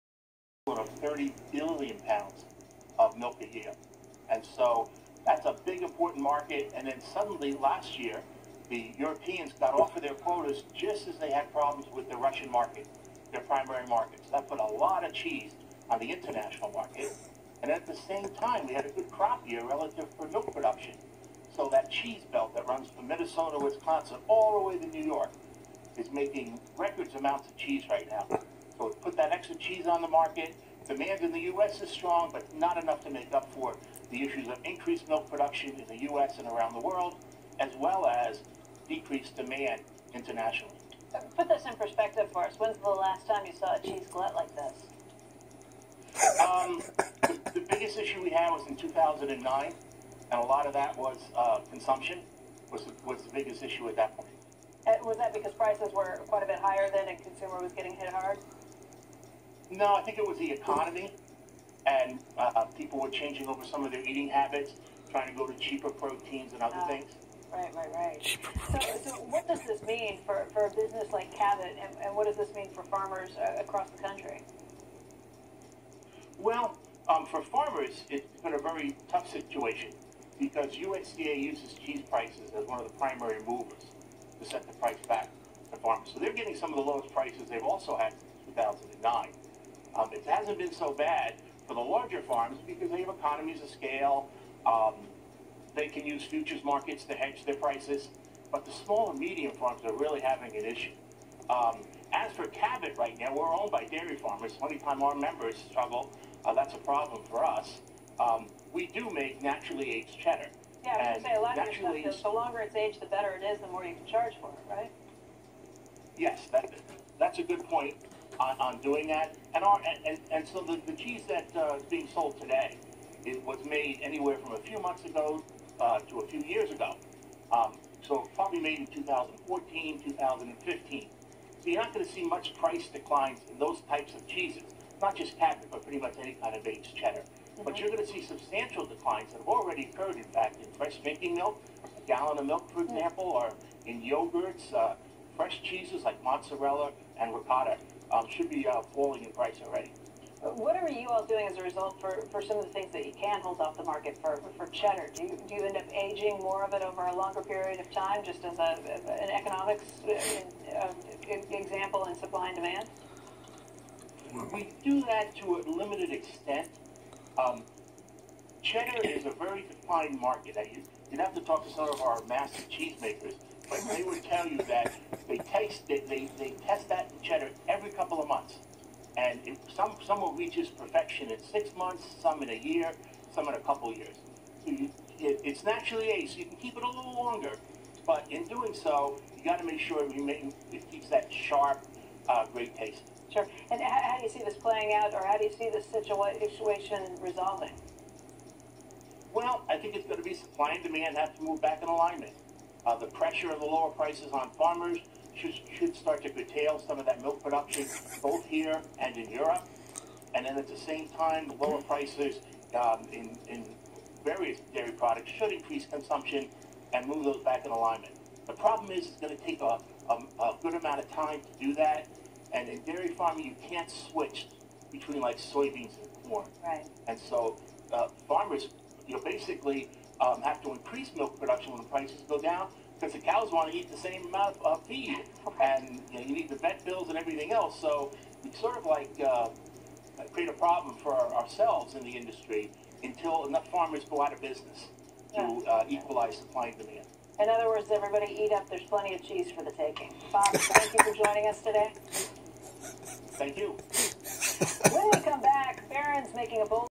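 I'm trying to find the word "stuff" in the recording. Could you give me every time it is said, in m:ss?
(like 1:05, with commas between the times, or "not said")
1:52.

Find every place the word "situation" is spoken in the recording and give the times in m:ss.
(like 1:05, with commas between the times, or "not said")
1:19, 3:15.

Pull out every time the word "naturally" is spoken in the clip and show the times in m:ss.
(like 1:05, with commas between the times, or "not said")
1:49, 3:05.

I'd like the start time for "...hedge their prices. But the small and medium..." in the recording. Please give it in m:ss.
1:37.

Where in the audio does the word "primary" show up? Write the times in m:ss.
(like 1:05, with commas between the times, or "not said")
0:13, 1:22.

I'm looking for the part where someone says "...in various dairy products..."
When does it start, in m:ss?
3:33.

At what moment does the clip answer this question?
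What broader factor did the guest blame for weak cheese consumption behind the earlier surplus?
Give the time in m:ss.
1:00.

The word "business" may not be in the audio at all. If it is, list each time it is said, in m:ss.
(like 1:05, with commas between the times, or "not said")
1:10, 4:04.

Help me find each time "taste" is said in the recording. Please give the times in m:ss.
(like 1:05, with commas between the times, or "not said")
2:55, 3:12.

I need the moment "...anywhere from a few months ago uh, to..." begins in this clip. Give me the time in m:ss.
2:04.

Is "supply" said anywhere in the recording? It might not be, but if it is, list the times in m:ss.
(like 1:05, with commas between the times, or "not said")
2:42, 3:20, 4:06.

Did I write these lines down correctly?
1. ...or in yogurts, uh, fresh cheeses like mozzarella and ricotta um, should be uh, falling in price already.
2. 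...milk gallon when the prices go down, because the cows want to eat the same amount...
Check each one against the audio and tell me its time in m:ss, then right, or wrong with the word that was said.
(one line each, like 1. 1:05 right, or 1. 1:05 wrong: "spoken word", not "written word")
1. 2:23 right
2. 3:51 wrong: "production", not "gallon".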